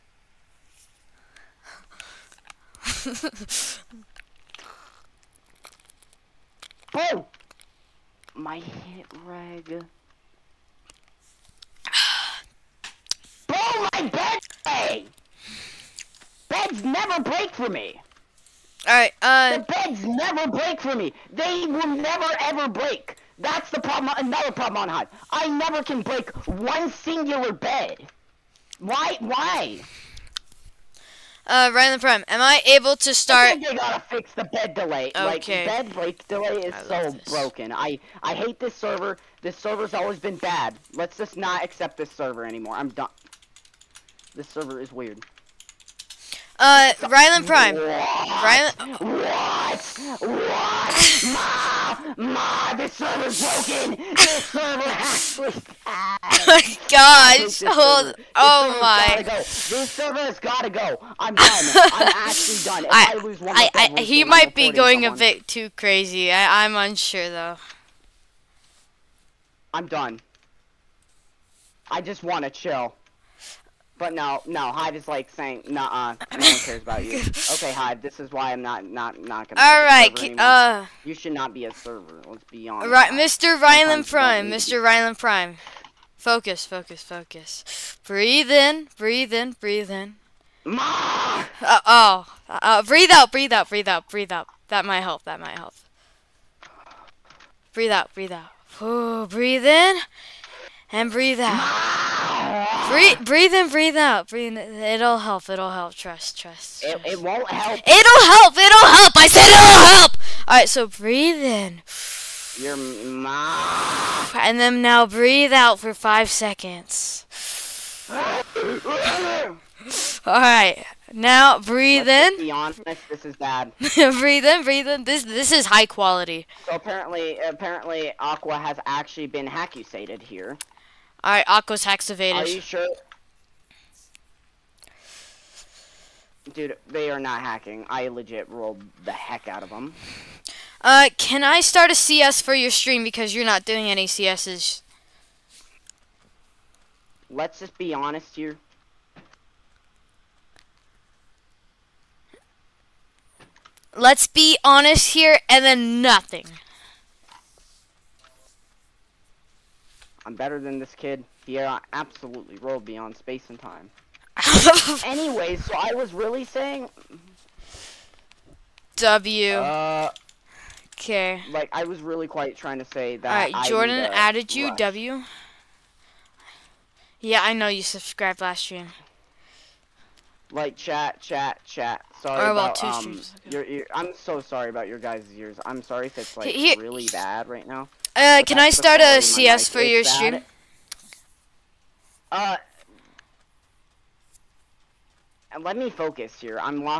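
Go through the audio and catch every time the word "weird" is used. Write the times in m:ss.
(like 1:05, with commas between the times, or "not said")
0:44.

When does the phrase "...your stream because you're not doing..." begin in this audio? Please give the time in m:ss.
2:22.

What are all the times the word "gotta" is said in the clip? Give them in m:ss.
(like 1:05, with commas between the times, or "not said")
0:33, 1:00.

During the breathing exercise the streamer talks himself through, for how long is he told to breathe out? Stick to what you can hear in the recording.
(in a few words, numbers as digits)
5 seconds.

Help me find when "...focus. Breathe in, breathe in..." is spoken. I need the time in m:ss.
1:27.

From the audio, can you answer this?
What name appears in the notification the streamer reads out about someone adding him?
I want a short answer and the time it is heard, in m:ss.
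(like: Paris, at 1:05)
Jordan, at 2:53.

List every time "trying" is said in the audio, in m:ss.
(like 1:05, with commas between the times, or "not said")
2:52.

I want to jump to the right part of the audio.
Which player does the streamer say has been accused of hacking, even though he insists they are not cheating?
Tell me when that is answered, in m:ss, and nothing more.
2:08.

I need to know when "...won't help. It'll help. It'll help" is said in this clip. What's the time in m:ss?
1:47.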